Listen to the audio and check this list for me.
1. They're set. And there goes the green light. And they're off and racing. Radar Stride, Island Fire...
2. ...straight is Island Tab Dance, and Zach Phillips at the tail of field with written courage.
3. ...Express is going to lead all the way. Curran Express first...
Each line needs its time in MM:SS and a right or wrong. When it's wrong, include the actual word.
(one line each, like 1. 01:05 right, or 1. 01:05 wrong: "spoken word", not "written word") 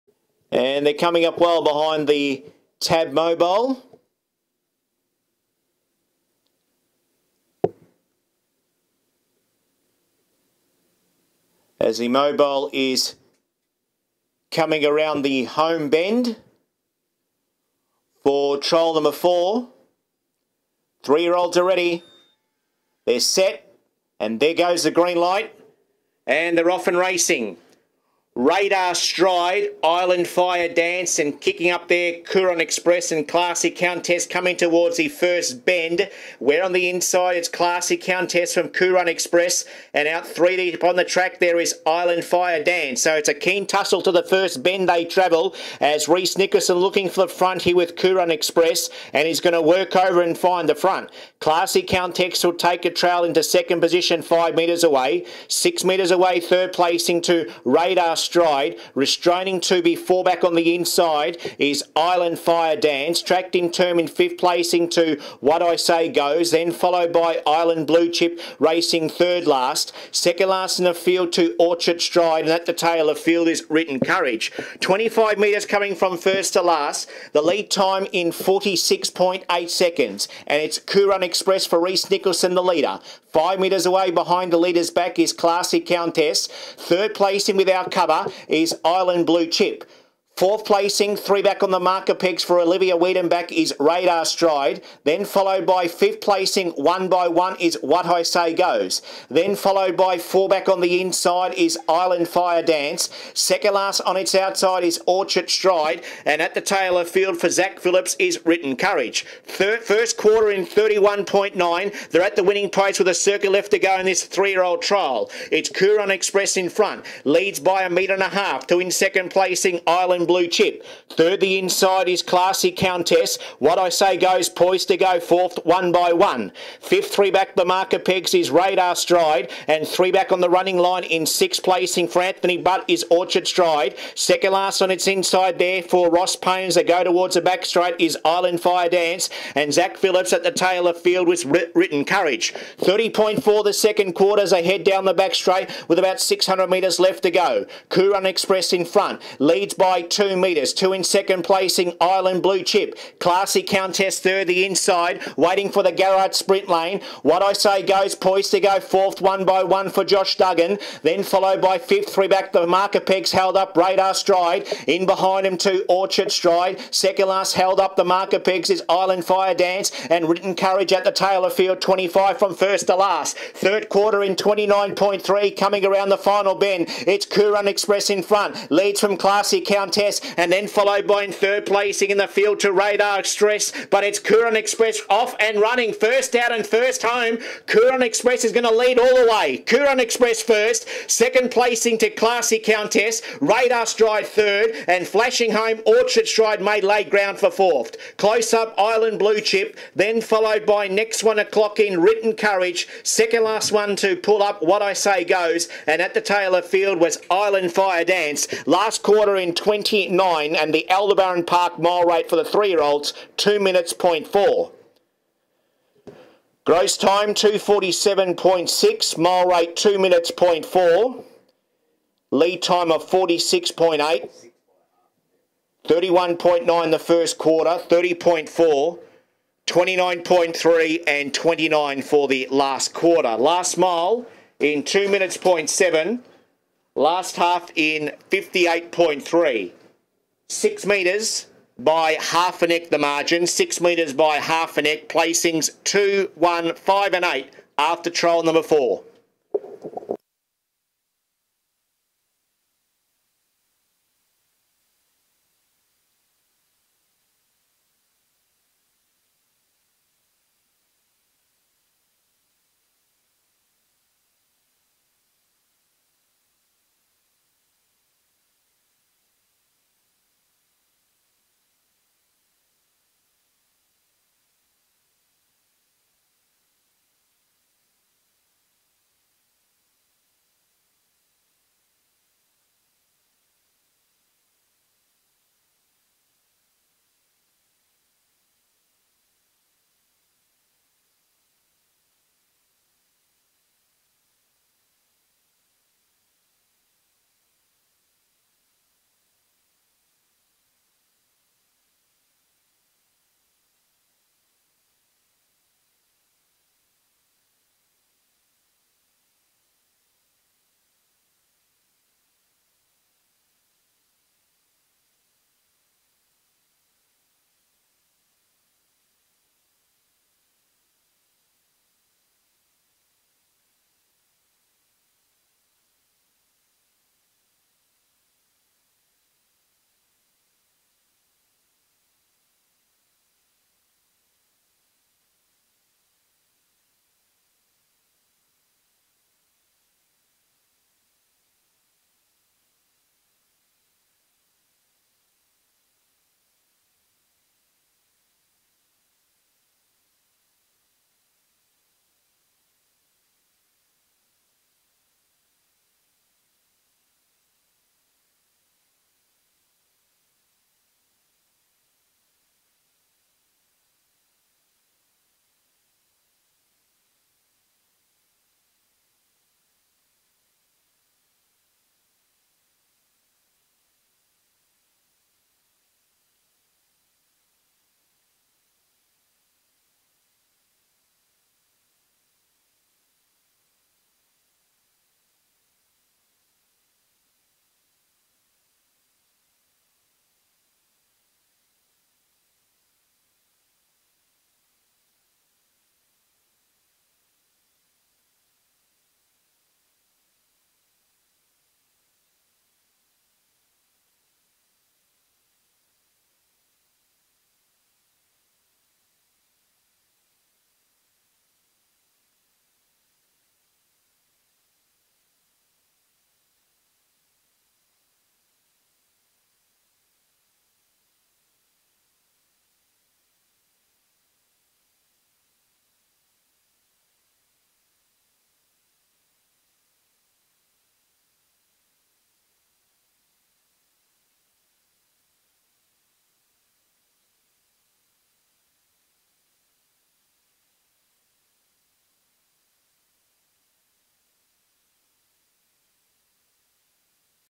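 1. 00:23 right
2. 02:17 wrong: "Fire", not "Tab"
3. 03:08 right.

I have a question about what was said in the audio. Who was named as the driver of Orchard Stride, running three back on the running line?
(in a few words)
Anthony Butt.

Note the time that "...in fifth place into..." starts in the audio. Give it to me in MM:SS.
01:03.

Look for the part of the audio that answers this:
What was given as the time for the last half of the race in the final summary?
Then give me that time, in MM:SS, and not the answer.
03:58.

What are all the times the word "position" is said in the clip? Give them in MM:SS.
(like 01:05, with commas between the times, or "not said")
00:53.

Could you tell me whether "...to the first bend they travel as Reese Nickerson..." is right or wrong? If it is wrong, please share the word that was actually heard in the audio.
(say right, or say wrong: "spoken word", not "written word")
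right.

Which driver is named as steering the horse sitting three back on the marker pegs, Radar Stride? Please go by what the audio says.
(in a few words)
Olivia Wiedenbach.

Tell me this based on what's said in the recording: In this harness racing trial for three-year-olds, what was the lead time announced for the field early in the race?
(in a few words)
46.8 seconds.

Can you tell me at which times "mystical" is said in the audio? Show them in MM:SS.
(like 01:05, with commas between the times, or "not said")
not said.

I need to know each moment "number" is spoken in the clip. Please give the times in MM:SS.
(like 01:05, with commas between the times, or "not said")
00:18, 04:08.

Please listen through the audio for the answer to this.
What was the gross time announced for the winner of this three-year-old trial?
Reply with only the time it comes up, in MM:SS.
03:37.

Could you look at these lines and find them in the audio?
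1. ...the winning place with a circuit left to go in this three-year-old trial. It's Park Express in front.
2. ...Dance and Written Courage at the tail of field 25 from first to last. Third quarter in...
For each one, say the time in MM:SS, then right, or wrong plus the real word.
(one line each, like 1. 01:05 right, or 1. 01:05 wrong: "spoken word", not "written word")
1. 01:52 wrong: "Curran", not "Park"
2. 02:49 right.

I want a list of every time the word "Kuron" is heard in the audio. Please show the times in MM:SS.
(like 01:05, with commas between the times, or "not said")
00:32, 00:38, 00:47.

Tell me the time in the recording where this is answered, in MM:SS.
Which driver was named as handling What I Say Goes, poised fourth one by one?
02:40.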